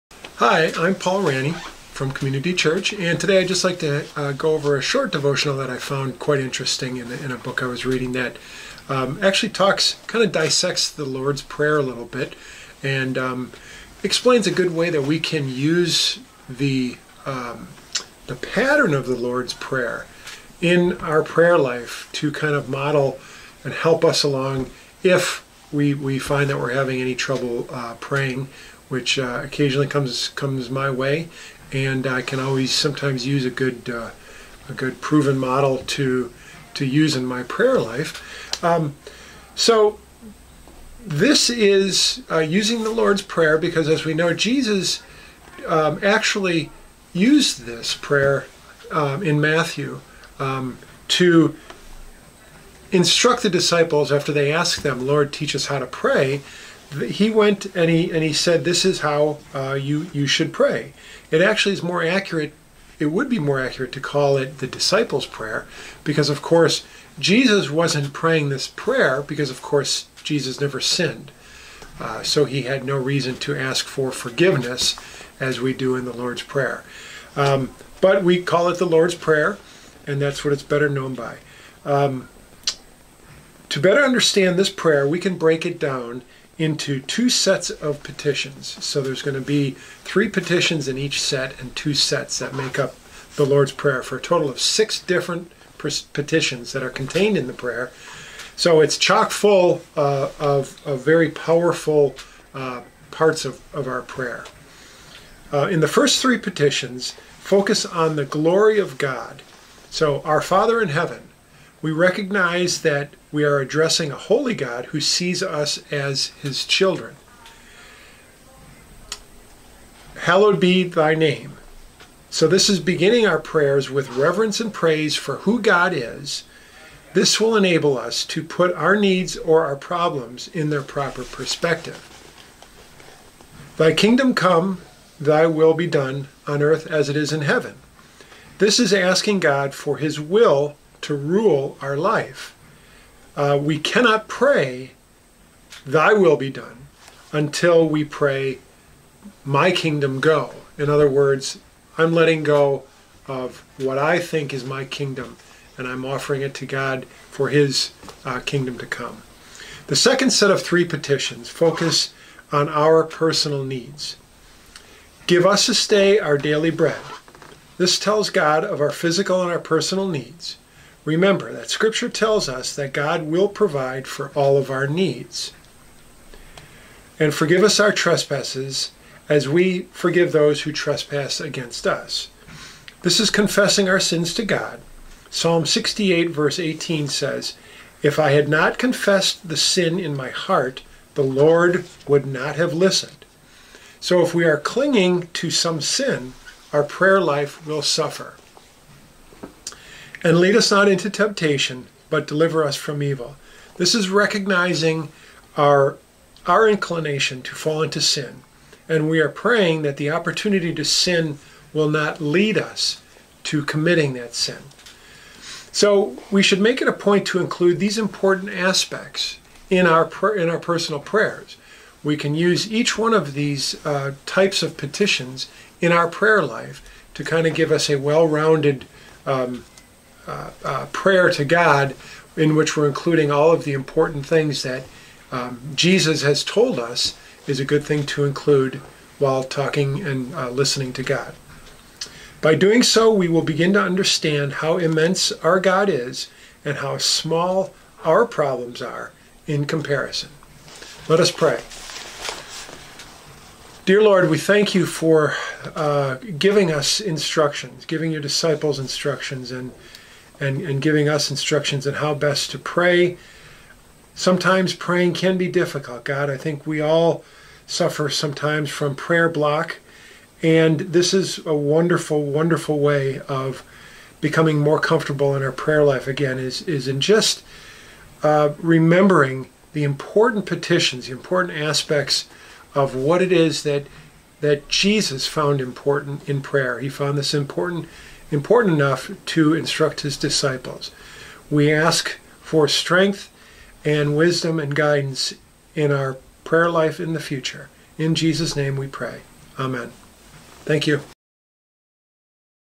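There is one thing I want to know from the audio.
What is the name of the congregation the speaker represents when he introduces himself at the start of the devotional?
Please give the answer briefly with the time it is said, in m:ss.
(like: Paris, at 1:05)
Community Church, at 0:02.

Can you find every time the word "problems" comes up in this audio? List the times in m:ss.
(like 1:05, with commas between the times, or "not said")
2:09, 4:08.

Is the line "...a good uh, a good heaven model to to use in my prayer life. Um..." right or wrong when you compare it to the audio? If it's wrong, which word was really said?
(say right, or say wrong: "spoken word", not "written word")
wrong: "proven", not "heaven".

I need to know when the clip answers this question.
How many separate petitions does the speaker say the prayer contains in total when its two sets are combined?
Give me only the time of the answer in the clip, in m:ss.
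1:34.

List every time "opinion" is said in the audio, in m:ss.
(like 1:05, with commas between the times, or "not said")
not said.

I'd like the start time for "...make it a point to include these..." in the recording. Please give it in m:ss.
3:36.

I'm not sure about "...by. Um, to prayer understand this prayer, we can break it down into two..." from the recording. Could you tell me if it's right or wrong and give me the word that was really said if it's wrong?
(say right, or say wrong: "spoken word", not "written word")
wrong: "better", not "prayer".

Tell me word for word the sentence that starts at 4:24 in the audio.
Sometimes praying can be difficult, God.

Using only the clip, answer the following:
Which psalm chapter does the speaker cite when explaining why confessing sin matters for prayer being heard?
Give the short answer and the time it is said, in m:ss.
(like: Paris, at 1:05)
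Psalm 68, at 3:05.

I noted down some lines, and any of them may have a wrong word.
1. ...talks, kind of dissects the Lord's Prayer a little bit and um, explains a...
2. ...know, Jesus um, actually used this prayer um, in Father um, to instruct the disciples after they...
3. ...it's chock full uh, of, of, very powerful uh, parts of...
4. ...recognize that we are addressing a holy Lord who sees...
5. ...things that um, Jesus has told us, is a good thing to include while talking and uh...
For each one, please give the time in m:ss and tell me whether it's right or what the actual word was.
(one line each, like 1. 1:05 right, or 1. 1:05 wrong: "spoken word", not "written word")
1. 0:09 right
2. 0:44 wrong: "Matthew", not "Father"
3. 1:38 right
4. 1:51 wrong: "God", not "Lord"
5. 3:54 right.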